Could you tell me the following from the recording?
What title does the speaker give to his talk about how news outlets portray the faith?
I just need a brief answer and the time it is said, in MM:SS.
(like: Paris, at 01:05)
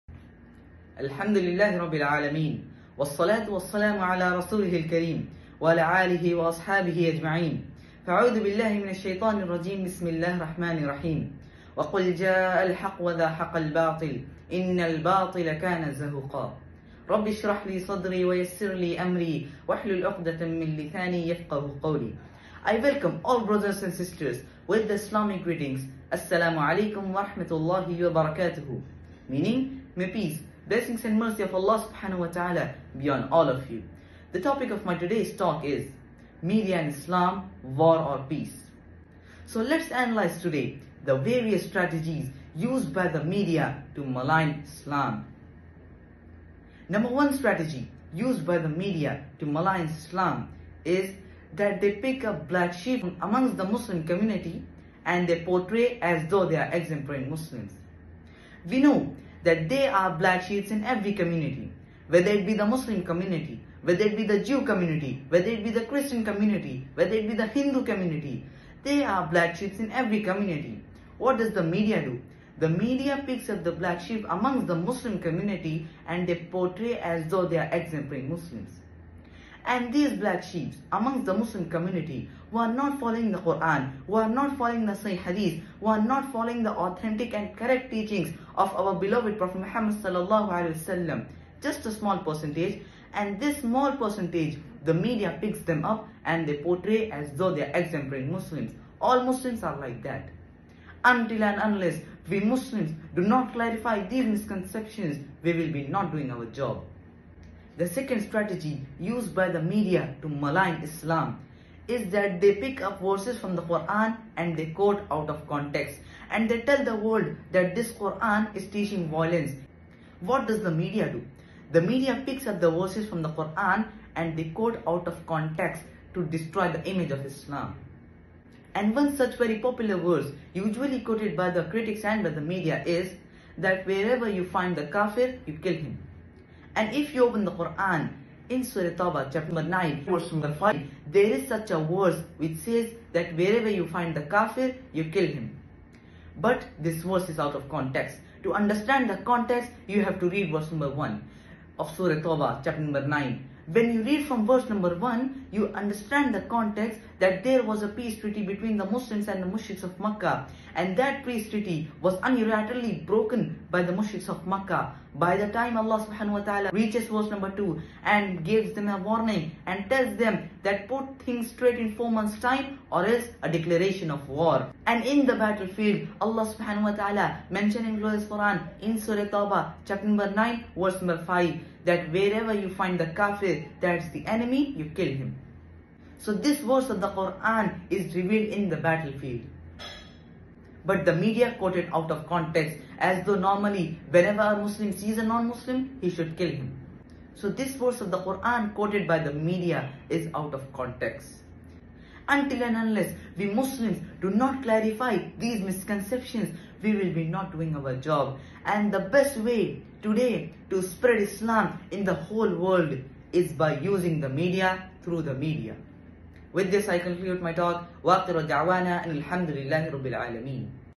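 Media and Islam, War or Peace, at 00:36.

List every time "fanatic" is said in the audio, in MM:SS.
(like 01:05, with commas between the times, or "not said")
not said.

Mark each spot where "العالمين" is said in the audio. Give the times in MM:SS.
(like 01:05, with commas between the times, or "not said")
00:01, 03:40.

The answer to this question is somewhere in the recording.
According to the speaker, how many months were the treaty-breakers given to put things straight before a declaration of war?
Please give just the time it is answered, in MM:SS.
02:51.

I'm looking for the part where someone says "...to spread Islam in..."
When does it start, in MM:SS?
03:30.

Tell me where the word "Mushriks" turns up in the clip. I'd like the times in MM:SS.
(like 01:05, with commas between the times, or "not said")
02:39, 02:43.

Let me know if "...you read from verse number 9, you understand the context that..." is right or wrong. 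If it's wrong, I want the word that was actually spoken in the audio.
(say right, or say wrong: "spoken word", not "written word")
wrong: "1", not "9".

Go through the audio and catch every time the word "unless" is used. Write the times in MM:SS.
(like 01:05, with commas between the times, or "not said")
01:41, 03:22.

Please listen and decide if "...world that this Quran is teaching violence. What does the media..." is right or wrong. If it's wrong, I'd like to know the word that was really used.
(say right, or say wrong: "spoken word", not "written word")
right.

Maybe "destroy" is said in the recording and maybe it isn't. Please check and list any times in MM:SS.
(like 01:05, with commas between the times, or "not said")
02:06.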